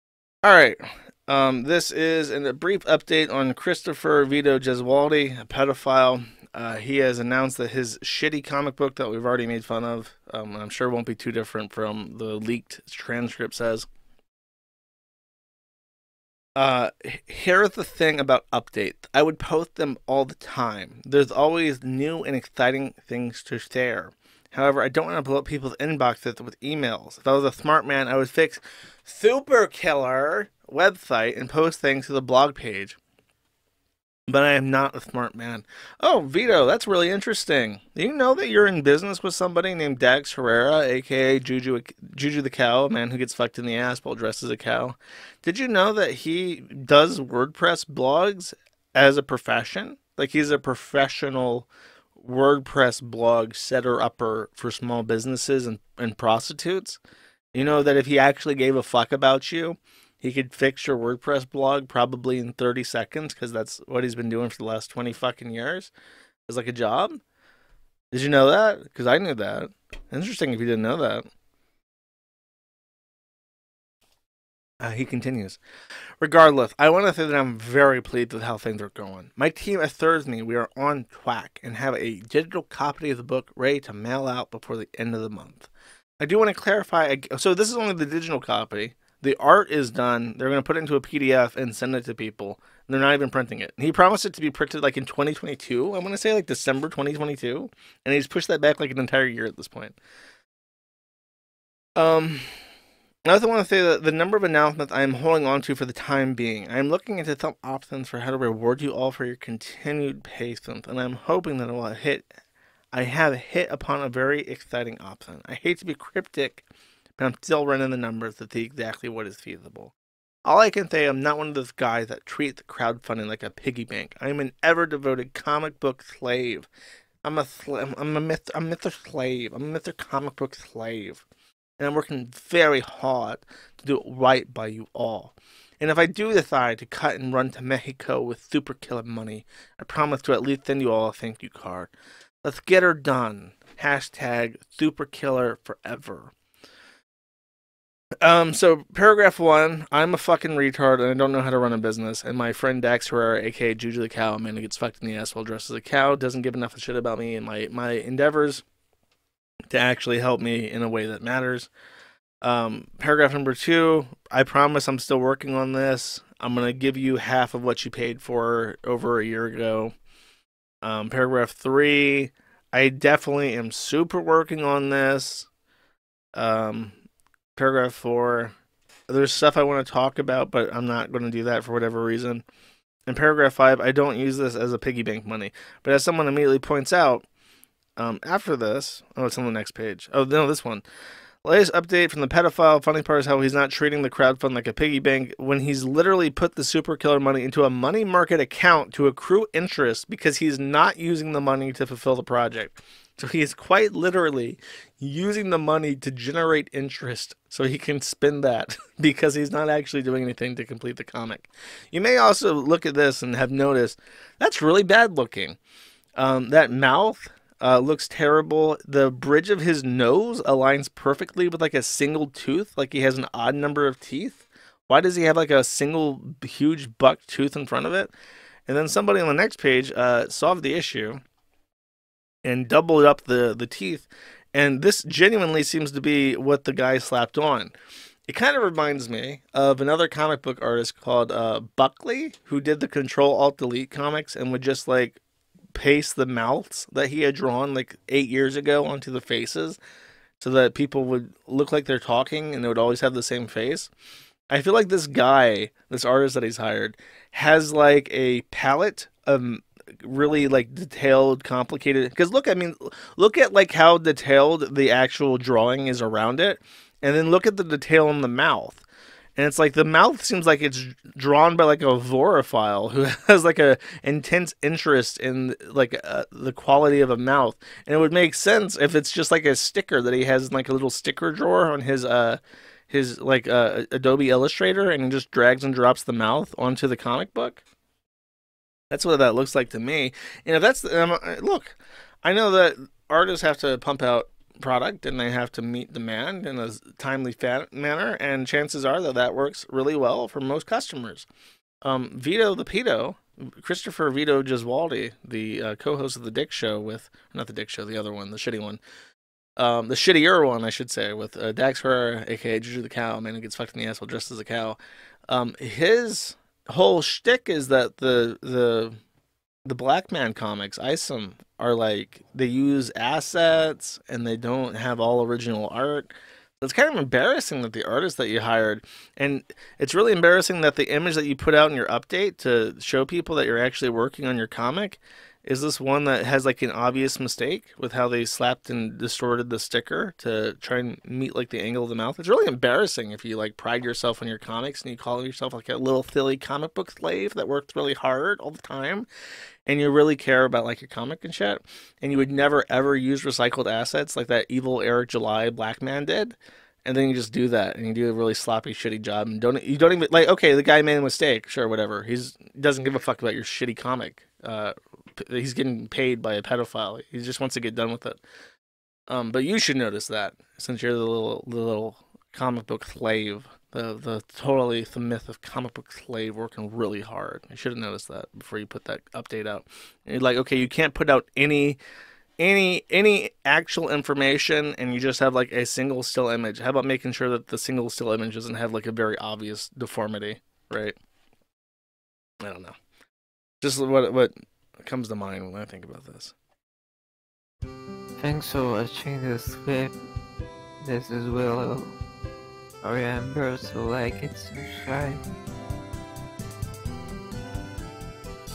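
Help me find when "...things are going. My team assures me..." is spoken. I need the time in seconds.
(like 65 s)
78 s.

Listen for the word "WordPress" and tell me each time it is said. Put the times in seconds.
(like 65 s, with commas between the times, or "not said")
47 s, 52 s, 60 s.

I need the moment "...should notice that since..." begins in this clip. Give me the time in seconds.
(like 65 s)
369 s.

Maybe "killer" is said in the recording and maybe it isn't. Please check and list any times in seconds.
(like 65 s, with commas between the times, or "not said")
29 s, 138 s, 145 s, 196 s.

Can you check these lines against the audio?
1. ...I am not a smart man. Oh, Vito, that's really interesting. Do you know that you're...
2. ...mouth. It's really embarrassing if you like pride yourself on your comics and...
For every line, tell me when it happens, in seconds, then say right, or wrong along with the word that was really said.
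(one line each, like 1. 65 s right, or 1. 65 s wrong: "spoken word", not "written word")
1. 34 s right
2. 341 s right.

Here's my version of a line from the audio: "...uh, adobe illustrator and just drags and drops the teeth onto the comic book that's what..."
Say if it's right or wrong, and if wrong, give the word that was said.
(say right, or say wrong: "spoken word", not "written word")
wrong: "mouth", not "teeth".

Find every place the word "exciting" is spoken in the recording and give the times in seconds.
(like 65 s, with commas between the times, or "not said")
22 s, 114 s.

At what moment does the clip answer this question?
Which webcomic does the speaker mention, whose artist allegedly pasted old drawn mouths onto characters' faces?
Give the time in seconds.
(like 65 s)
242 s.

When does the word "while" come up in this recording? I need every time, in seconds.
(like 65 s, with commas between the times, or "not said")
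43 s, 155 s.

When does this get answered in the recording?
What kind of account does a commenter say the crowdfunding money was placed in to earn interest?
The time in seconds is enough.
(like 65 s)
197 s.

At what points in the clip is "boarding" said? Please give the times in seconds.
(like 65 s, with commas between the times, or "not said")
not said.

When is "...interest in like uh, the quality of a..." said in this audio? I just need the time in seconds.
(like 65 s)
274 s.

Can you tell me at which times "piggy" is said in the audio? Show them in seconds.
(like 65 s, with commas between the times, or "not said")
123 s, 184 s, 194 s.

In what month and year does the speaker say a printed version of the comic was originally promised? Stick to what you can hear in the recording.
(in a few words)
December 2022.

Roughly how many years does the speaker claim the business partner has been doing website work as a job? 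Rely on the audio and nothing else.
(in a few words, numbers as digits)
20.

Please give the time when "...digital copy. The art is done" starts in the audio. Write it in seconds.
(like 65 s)
88 s.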